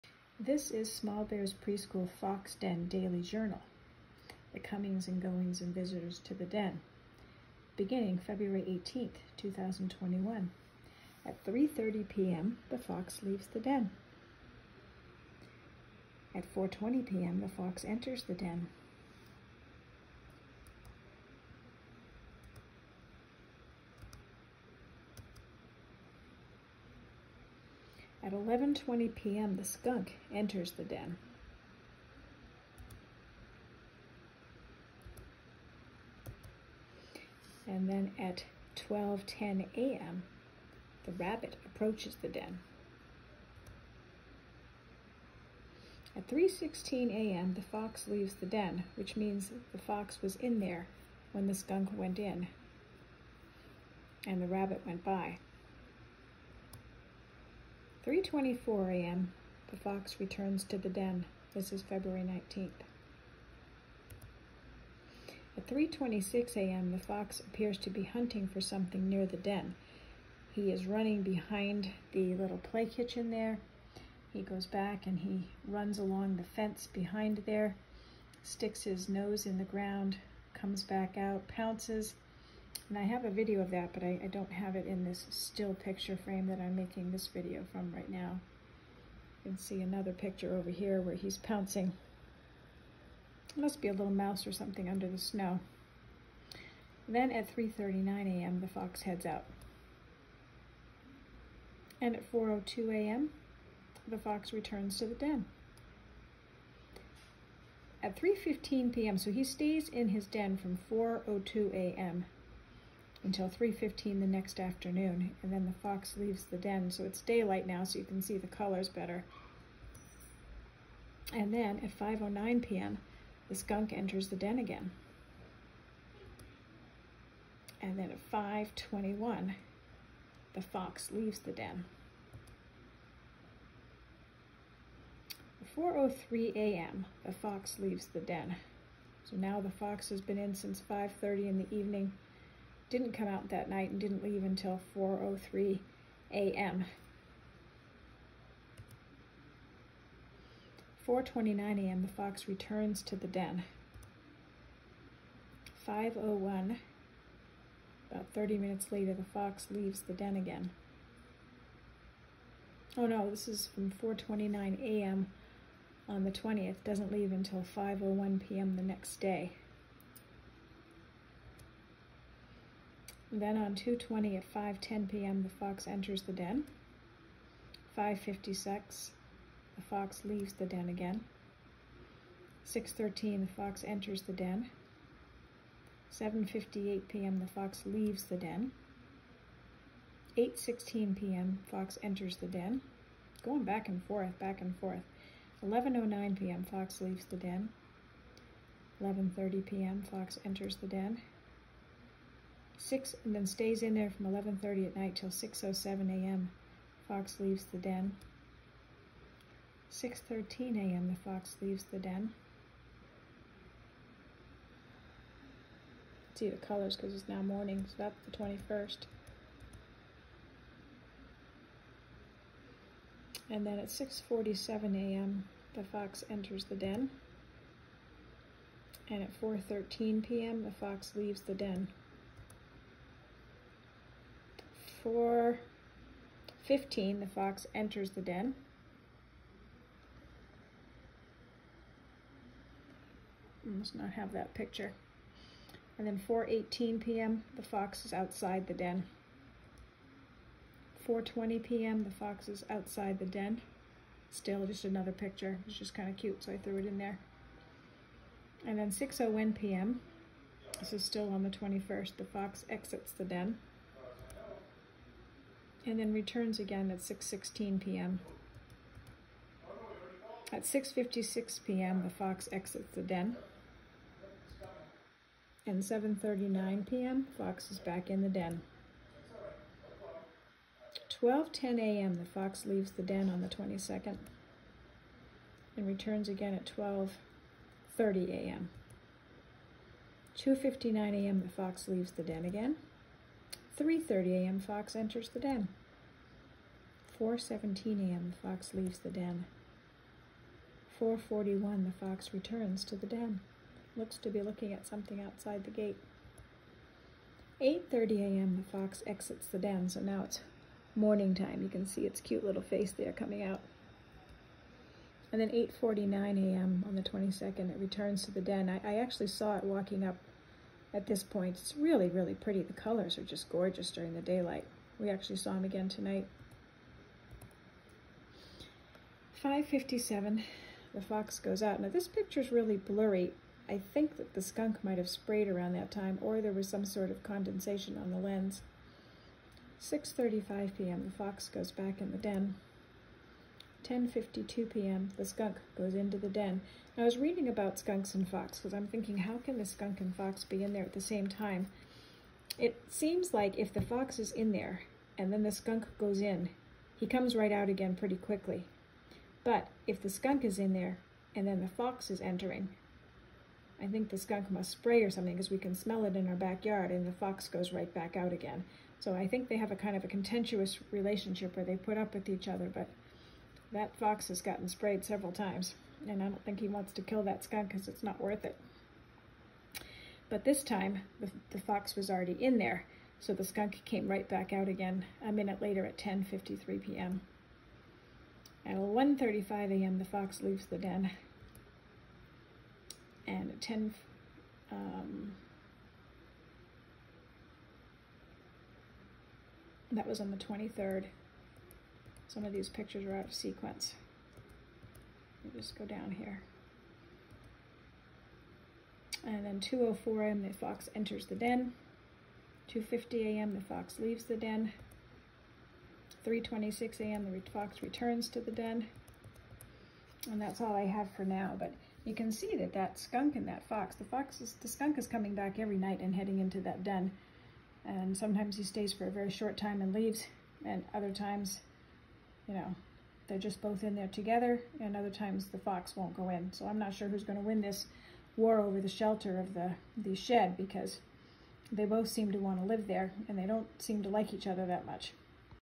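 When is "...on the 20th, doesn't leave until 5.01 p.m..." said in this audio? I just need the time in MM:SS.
02:46.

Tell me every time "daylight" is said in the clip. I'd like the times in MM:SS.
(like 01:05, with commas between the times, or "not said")
01:57, 05:24.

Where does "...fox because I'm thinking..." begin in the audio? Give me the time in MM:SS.
05:48.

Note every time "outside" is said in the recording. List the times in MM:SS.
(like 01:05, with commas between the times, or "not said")
04:08, 04:12, 05:05.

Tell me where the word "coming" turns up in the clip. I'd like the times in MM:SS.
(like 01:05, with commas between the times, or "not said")
00:04, 05:13, 07:05.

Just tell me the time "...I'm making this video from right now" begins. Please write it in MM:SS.
01:26.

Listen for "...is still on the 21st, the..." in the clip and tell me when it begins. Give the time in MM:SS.
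04:20.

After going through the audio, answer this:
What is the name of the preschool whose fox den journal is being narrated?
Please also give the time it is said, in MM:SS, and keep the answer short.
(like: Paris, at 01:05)
Small Bear's Preschool, at 00:00.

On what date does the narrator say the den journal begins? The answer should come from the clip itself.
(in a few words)
February 18th, 2021.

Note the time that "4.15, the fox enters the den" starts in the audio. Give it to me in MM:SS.
03:55.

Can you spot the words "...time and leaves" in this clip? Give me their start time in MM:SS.
07:09.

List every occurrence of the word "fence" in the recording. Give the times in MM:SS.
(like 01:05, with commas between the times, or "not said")
01:16.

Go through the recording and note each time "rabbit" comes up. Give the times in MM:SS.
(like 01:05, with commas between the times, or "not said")
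00:41, 00:54.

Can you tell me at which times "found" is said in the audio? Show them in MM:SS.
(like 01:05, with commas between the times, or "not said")
not said.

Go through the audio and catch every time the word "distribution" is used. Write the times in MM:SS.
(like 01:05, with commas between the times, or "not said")
not said.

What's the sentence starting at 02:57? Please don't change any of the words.
5.56, the fox leaves the den again.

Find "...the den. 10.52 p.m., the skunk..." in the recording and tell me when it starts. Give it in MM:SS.
05:42.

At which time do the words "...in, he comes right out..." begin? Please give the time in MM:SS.
05:56.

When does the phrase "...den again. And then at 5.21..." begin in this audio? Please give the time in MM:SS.
02:04.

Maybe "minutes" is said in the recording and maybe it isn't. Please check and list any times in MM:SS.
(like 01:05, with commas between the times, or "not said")
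02:38, 06:25.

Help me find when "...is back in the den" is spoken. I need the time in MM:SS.
04:37.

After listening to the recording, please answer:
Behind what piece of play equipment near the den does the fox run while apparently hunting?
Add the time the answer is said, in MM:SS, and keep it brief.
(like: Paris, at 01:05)
play kitchen, at 01:12.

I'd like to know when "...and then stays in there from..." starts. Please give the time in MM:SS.
03:23.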